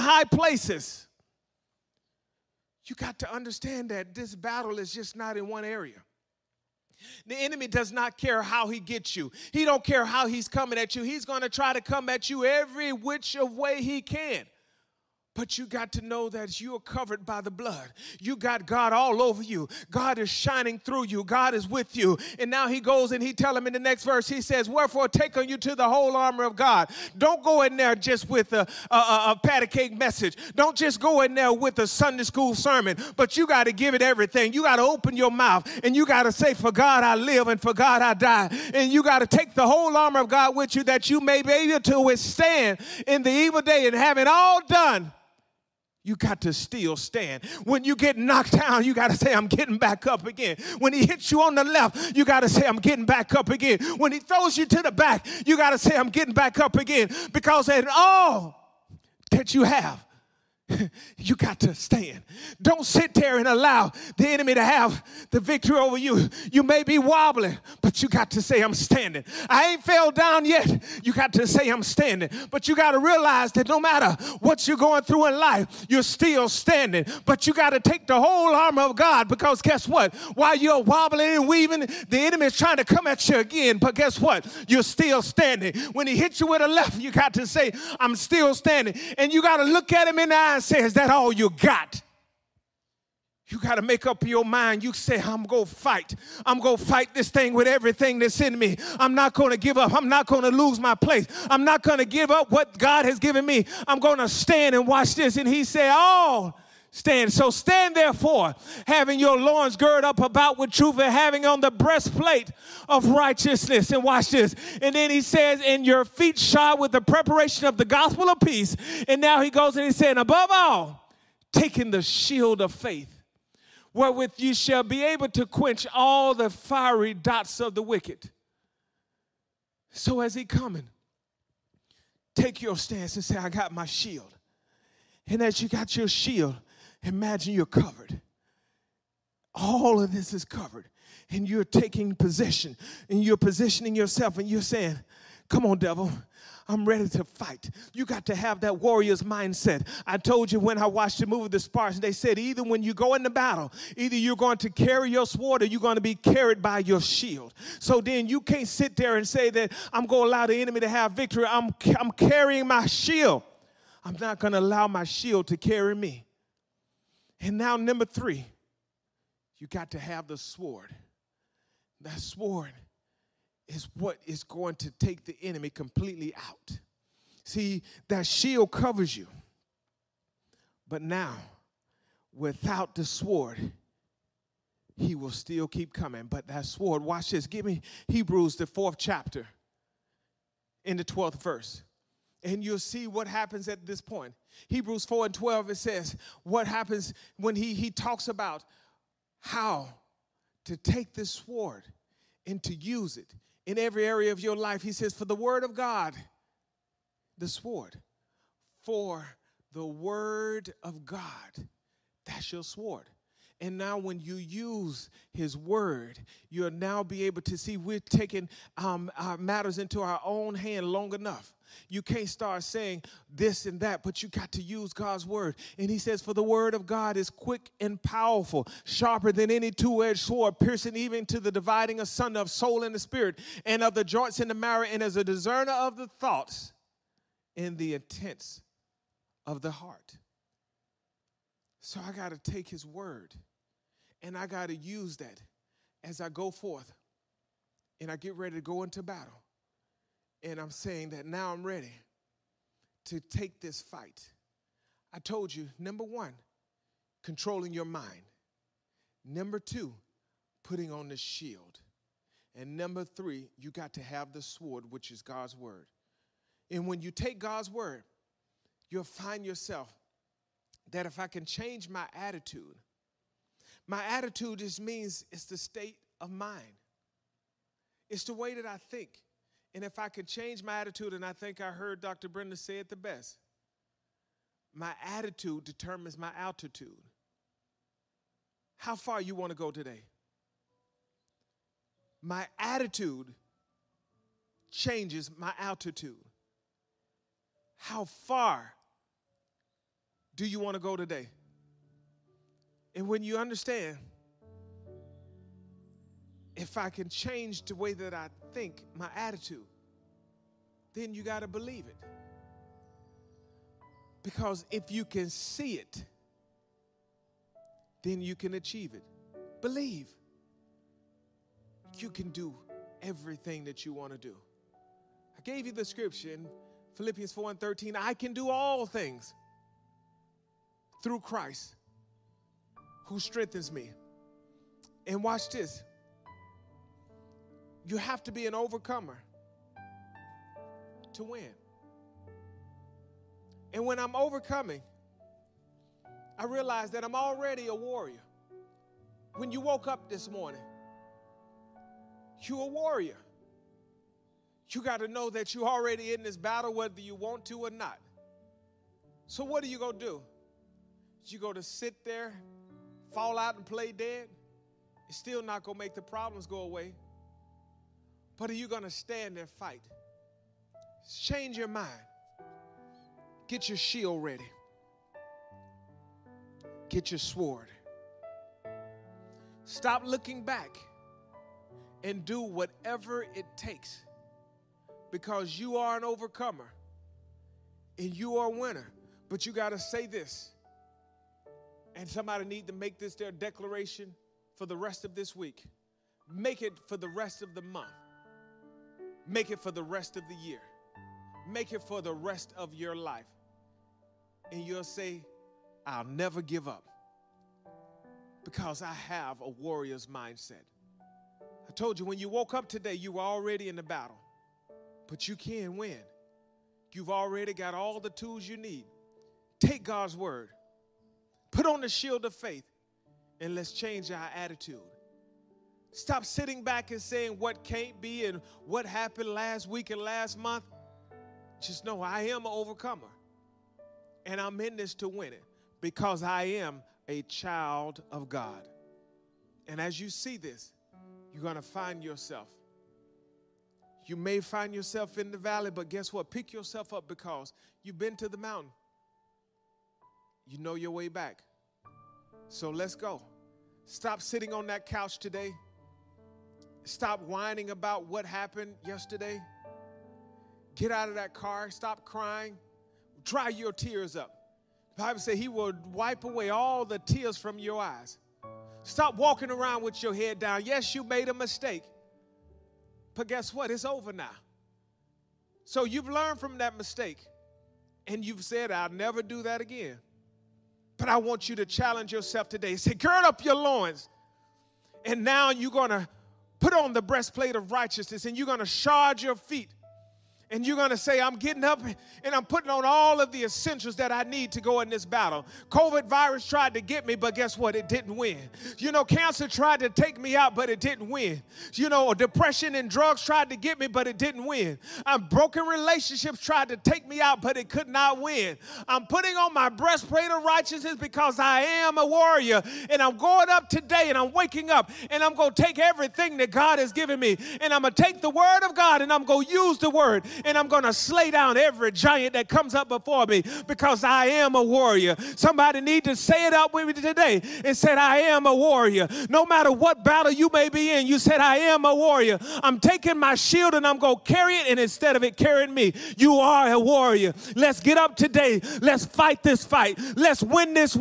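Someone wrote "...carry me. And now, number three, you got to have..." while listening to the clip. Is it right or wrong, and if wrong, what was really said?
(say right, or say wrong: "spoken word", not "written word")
right.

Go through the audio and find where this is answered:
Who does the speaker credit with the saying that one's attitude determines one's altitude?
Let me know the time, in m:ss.
4:42.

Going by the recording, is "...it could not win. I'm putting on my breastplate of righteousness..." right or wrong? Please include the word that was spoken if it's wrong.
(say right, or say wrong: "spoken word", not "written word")
right.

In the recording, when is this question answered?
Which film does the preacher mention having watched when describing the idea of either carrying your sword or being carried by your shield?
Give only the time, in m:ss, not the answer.
2:31.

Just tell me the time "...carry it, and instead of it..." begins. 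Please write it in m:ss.
8:54.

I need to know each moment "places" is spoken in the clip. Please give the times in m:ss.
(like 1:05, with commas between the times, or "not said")
0:00, 1:40.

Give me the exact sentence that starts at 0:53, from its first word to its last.
When he throws you to the back, you got to say, I'm getting back up again.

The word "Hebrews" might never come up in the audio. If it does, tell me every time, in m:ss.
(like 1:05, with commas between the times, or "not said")
3:08, 3:14.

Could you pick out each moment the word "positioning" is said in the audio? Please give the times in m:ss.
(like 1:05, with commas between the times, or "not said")
2:23.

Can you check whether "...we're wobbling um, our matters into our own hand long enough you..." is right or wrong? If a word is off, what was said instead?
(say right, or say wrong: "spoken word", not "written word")
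wrong: "taking", not "wobbling".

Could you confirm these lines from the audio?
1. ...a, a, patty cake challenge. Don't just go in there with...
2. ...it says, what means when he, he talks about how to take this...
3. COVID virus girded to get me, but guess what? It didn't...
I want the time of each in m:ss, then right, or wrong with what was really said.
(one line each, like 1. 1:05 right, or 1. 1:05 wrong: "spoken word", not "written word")
1. 0:28 wrong: "message", not "challenge"
2. 3:15 wrong: "happens", not "means"
3. 8:15 wrong: "tried", not "girded".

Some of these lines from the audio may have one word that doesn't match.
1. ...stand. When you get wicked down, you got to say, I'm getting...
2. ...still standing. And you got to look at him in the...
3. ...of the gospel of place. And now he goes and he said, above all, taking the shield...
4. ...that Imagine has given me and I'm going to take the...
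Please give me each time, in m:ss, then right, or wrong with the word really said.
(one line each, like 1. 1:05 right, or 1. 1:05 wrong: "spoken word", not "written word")
1. 0:46 wrong: "knocked", not "wicked"
2. 1:28 right
3. 1:57 wrong: "peace", not "place"
4. 8:36 wrong: "God", not "Imagine".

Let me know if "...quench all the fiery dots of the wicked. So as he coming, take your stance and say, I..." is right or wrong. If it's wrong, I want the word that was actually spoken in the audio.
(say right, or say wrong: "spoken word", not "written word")
right.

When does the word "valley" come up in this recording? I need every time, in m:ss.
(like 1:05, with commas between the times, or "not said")
7:25.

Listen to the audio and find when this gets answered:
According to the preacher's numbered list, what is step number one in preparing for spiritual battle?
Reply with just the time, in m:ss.
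4:17.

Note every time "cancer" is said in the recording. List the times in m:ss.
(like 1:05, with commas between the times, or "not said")
8:19.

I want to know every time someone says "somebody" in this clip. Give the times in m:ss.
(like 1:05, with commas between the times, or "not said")
6:32, 8:45.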